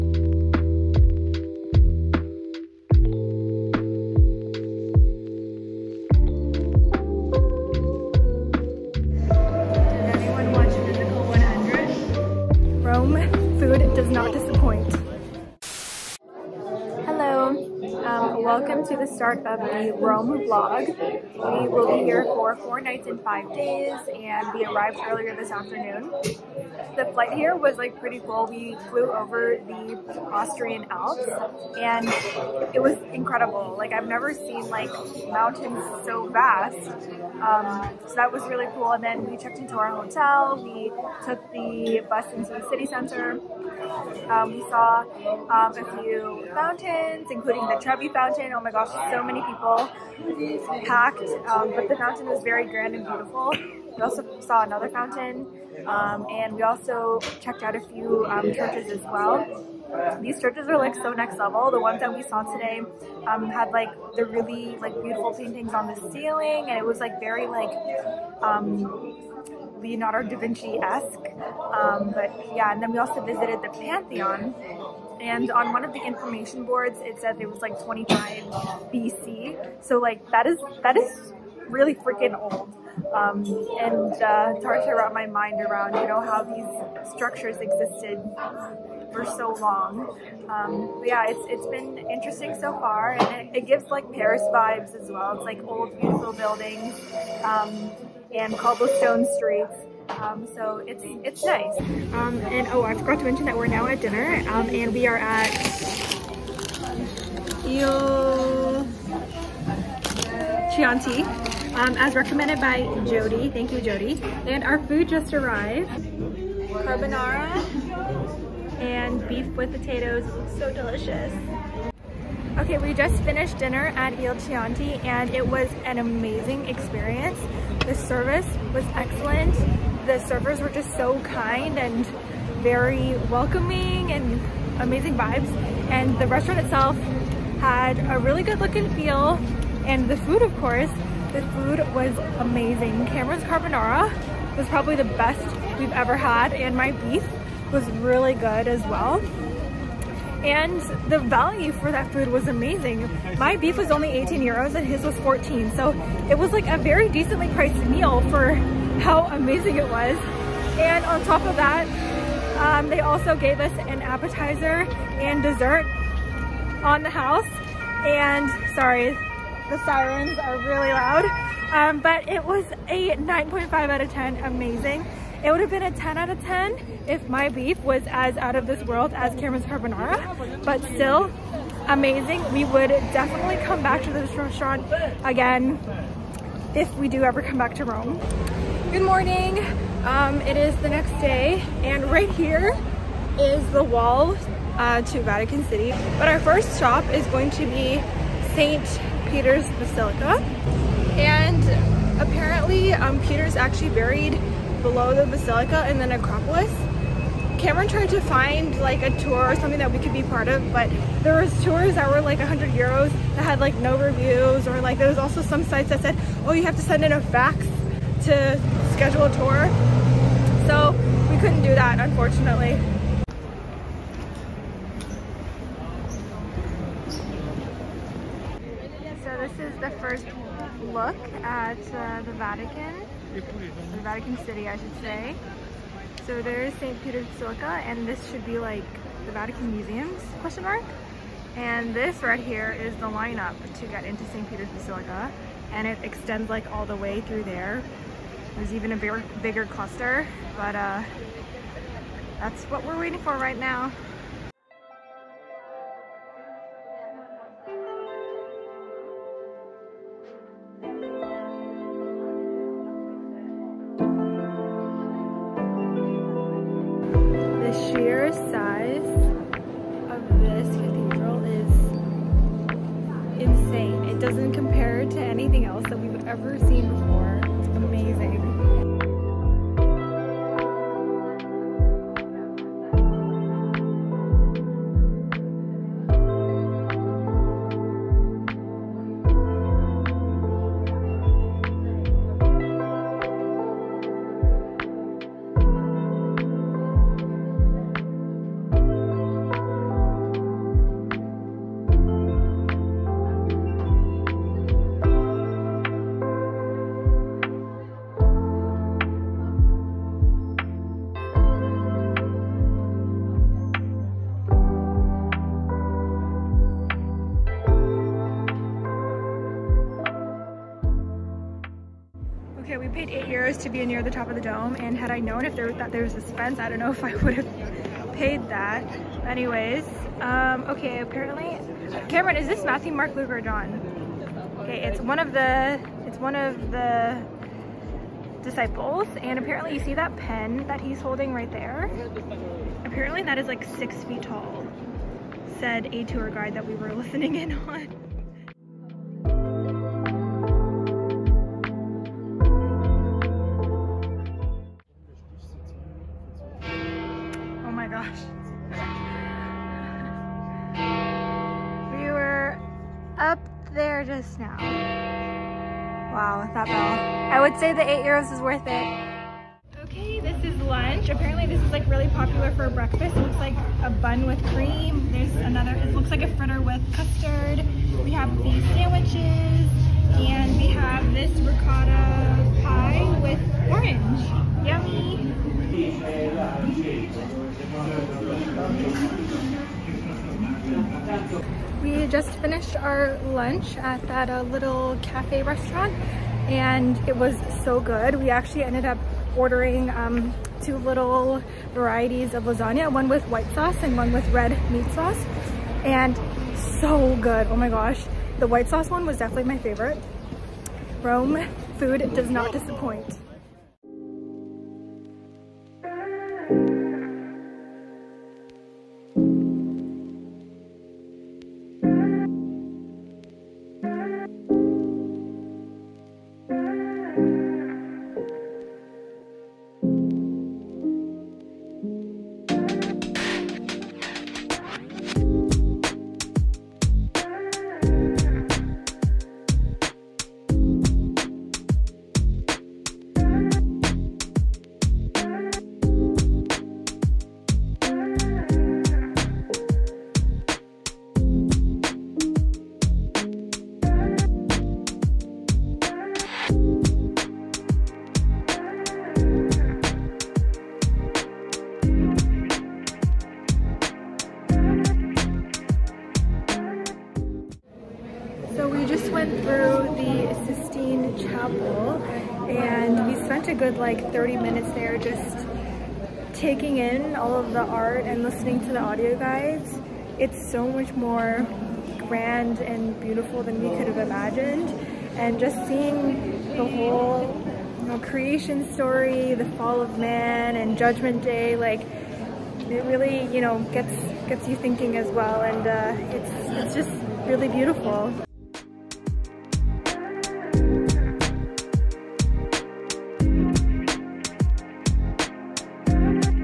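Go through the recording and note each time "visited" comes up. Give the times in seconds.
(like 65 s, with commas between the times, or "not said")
73 s.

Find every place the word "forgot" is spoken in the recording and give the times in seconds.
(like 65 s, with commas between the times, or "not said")
102 s.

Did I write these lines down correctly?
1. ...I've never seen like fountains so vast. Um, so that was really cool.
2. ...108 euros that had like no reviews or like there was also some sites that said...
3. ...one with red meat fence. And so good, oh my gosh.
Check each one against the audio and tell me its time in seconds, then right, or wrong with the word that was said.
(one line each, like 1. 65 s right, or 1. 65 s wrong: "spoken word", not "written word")
1. 33 s wrong: "mountains", not "fountains"
2. 212 s wrong: "100", not "108"
3. 403 s wrong: "sauce", not "fence".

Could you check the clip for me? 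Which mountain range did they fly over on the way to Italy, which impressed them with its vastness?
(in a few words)
Austrian Alps.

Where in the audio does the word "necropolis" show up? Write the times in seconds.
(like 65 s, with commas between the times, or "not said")
206 s.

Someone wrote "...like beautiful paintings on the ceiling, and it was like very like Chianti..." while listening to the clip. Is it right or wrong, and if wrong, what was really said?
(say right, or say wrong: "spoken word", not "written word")
wrong: "Leonardo", not "Chianti".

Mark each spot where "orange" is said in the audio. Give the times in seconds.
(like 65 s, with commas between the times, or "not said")
383 s.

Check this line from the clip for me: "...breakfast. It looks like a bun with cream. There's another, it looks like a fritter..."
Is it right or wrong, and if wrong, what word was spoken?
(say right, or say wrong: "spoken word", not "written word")
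right.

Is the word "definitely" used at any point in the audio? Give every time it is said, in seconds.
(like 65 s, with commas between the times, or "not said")
182 s, 409 s.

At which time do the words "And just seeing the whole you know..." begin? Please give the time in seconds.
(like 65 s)
485 s.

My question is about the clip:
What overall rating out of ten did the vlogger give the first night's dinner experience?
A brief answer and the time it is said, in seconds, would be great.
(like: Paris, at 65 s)
9.5, at 173 s.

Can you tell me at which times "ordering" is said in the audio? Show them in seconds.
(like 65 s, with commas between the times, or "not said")
399 s.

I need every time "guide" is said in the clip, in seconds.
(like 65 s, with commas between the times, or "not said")
346 s, 479 s.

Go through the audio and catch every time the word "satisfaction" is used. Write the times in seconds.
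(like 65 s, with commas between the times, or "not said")
not said.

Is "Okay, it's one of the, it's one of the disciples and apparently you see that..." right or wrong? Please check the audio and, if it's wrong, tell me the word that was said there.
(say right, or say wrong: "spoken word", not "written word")
right.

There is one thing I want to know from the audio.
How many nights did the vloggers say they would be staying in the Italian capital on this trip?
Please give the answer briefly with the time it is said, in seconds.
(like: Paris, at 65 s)
4, at 22 s.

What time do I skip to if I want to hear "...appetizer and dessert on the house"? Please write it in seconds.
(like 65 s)
164 s.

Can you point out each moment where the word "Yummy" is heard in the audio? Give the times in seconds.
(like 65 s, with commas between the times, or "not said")
384 s.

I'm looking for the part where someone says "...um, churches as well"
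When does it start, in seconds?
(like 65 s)
58 s.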